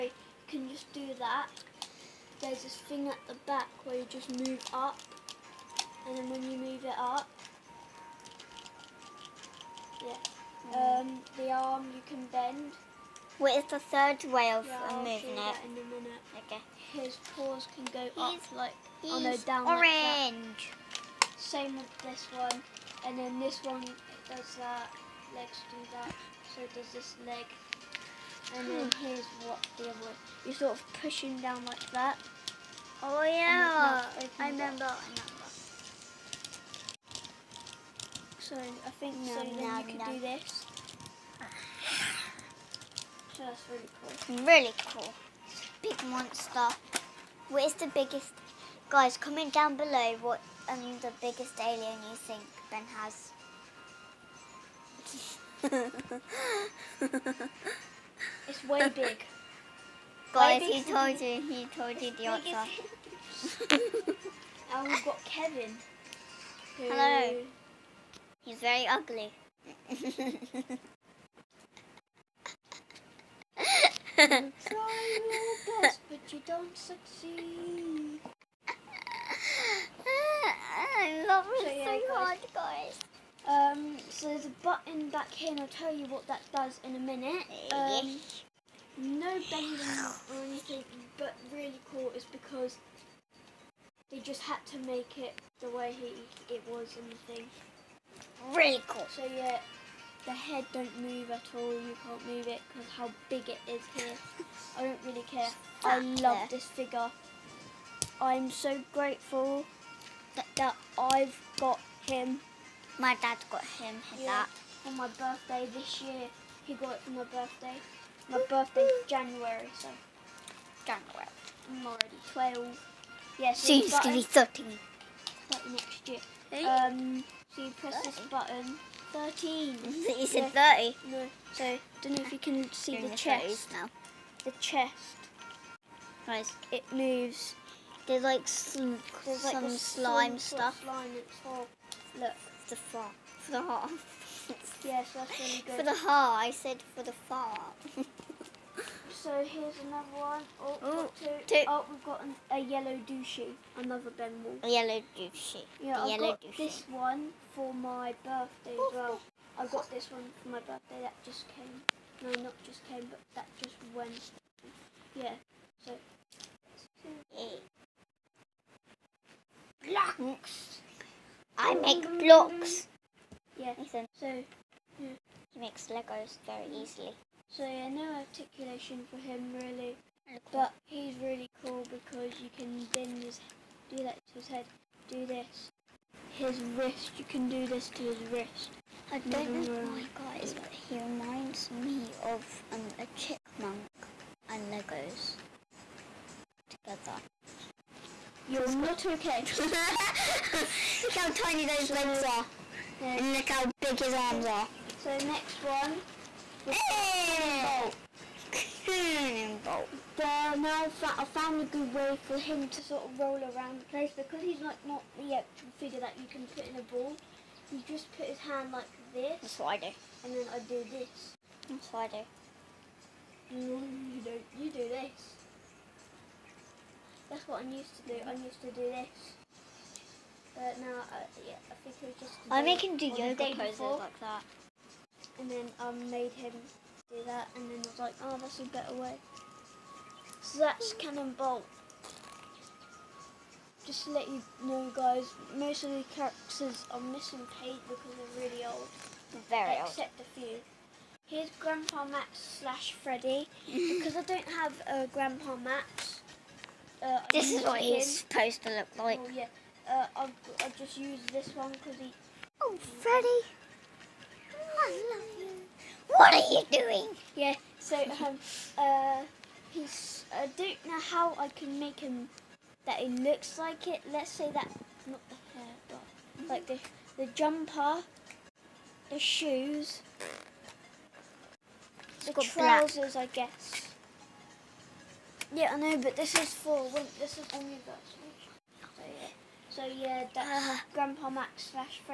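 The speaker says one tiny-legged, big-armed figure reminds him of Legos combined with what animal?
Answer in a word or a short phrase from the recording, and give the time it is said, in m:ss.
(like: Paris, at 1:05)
A chipmunk, at 3:12.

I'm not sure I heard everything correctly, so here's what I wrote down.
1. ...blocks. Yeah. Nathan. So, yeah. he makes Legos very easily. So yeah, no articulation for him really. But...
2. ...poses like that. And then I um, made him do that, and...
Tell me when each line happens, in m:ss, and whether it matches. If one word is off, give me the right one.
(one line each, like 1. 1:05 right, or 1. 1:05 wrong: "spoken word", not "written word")
1. 2:52 right
2. 3:53 right.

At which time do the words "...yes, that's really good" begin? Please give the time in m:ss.
2:24.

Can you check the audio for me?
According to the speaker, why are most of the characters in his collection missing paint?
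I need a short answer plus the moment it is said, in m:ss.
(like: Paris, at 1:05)
They're really old, at 4:08.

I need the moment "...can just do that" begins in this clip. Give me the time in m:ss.
0:00.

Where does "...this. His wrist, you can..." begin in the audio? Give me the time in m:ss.
3:05.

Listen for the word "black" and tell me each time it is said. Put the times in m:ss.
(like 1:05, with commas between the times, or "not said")
4:43.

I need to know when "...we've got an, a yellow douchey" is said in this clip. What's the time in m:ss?
2:31.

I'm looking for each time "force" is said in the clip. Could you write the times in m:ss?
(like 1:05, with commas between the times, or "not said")
not said.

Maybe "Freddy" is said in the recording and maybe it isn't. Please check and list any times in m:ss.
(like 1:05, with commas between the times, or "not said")
4:12, 4:22.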